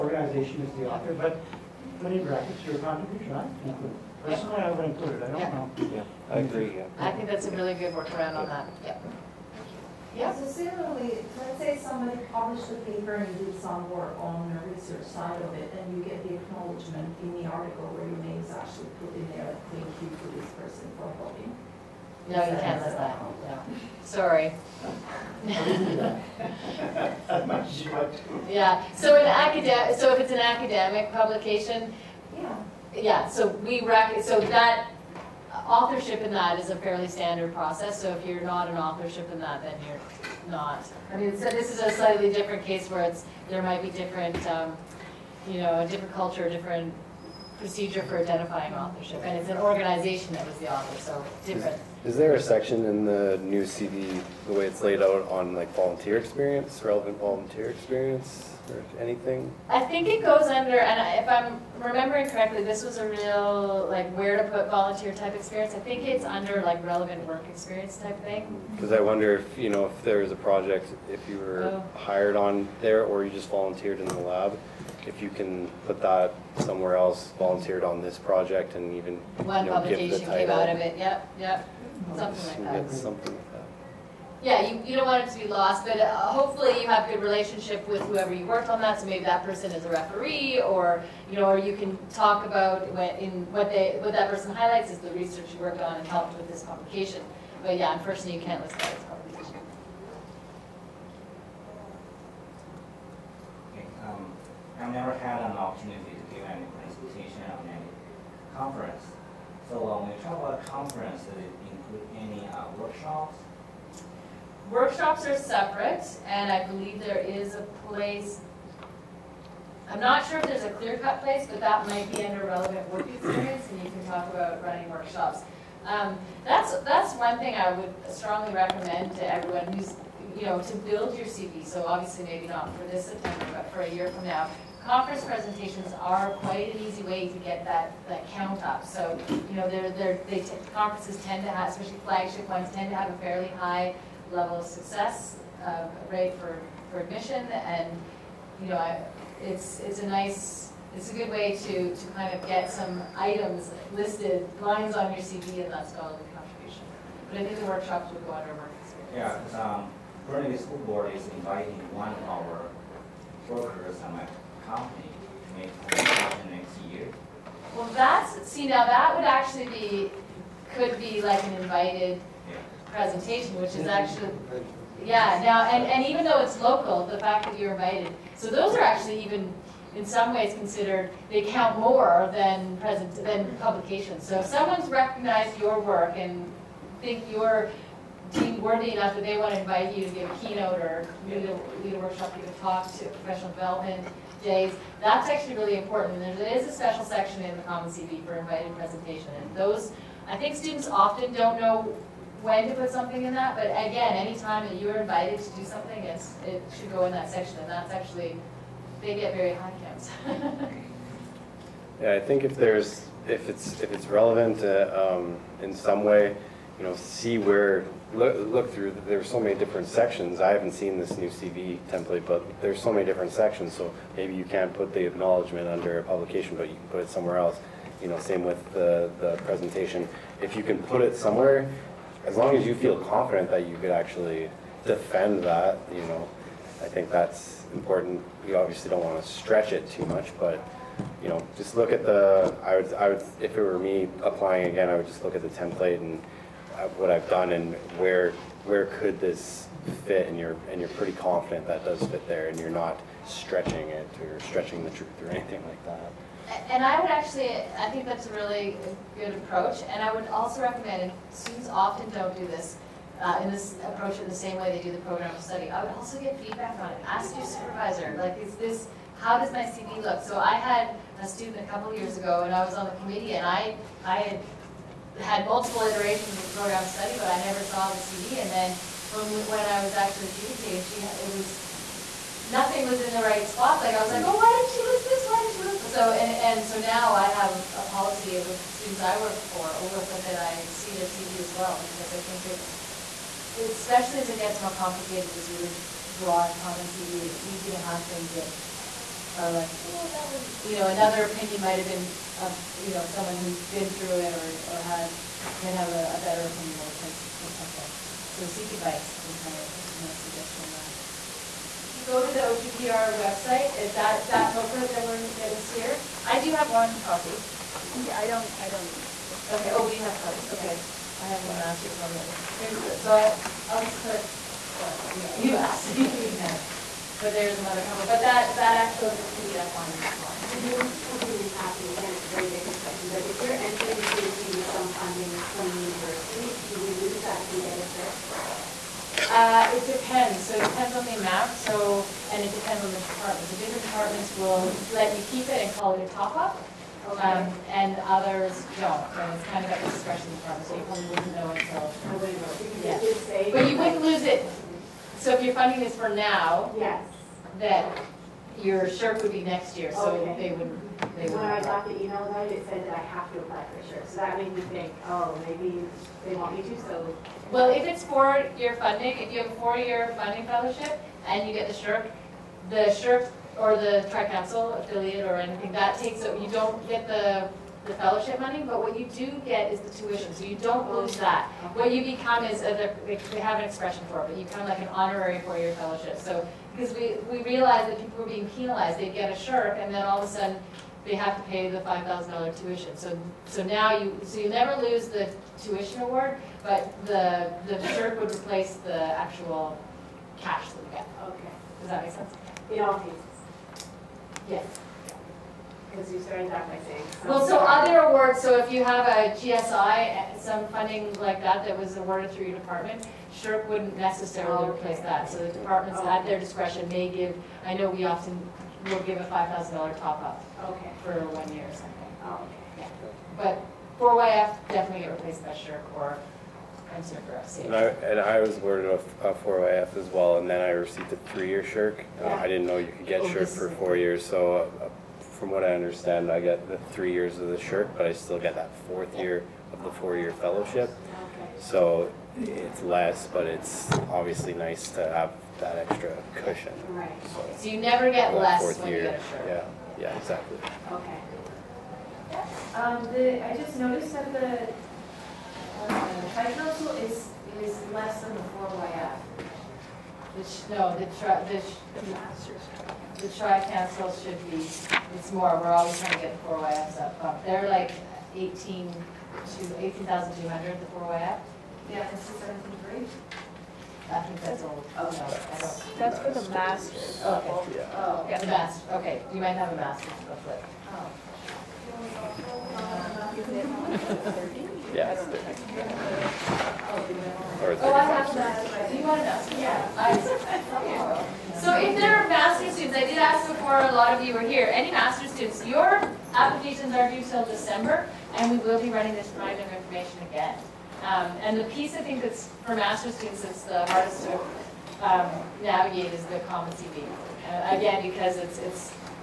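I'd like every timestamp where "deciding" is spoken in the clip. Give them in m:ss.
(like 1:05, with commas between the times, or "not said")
not said.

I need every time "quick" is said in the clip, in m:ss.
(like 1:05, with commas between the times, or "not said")
not said.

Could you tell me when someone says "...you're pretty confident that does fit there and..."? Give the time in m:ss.
4:10.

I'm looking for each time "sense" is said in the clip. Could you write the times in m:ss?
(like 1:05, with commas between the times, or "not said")
6:42.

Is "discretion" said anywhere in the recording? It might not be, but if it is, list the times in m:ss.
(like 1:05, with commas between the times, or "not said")
5:49, 6:56.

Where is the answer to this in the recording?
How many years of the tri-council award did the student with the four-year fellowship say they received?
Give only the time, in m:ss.
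7:11.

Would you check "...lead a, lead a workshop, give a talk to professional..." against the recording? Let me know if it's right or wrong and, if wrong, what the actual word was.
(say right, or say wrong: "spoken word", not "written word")
right.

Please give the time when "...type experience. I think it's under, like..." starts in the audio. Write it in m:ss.
1:05.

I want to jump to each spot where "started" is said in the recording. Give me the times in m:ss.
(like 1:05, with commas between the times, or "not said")
6:46.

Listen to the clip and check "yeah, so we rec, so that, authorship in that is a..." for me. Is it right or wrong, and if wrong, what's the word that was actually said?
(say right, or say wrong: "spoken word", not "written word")
right.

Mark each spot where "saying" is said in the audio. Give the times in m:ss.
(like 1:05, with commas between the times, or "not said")
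6:46.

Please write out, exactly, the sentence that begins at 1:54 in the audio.
Workshops are separate, and I believe there is a place.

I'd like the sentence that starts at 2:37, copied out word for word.
But I think the workshops would go under work experience.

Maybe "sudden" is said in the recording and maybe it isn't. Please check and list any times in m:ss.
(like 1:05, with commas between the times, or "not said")
6:30.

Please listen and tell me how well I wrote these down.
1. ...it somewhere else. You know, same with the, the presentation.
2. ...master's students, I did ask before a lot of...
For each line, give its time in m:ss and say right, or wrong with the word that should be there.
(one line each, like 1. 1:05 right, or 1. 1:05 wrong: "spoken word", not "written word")
1. 3:47 right
2. 8:12 right.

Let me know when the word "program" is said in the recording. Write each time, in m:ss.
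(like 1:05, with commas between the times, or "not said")
4:25, 4:36.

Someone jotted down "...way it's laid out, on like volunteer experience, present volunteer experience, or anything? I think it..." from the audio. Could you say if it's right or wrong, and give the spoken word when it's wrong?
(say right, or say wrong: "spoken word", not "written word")
wrong: "relevant", not "present".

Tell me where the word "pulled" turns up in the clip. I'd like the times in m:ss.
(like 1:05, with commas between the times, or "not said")
not said.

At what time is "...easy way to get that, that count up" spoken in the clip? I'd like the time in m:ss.
2:16.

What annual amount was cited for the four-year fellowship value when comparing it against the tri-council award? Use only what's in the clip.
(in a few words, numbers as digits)
$18,200.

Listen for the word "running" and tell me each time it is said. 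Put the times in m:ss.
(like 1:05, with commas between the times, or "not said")
2:04, 8:18.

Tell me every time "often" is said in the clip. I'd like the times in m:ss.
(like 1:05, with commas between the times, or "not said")
3:20, 4:21, 6:58.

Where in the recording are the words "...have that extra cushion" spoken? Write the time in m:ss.
7:25.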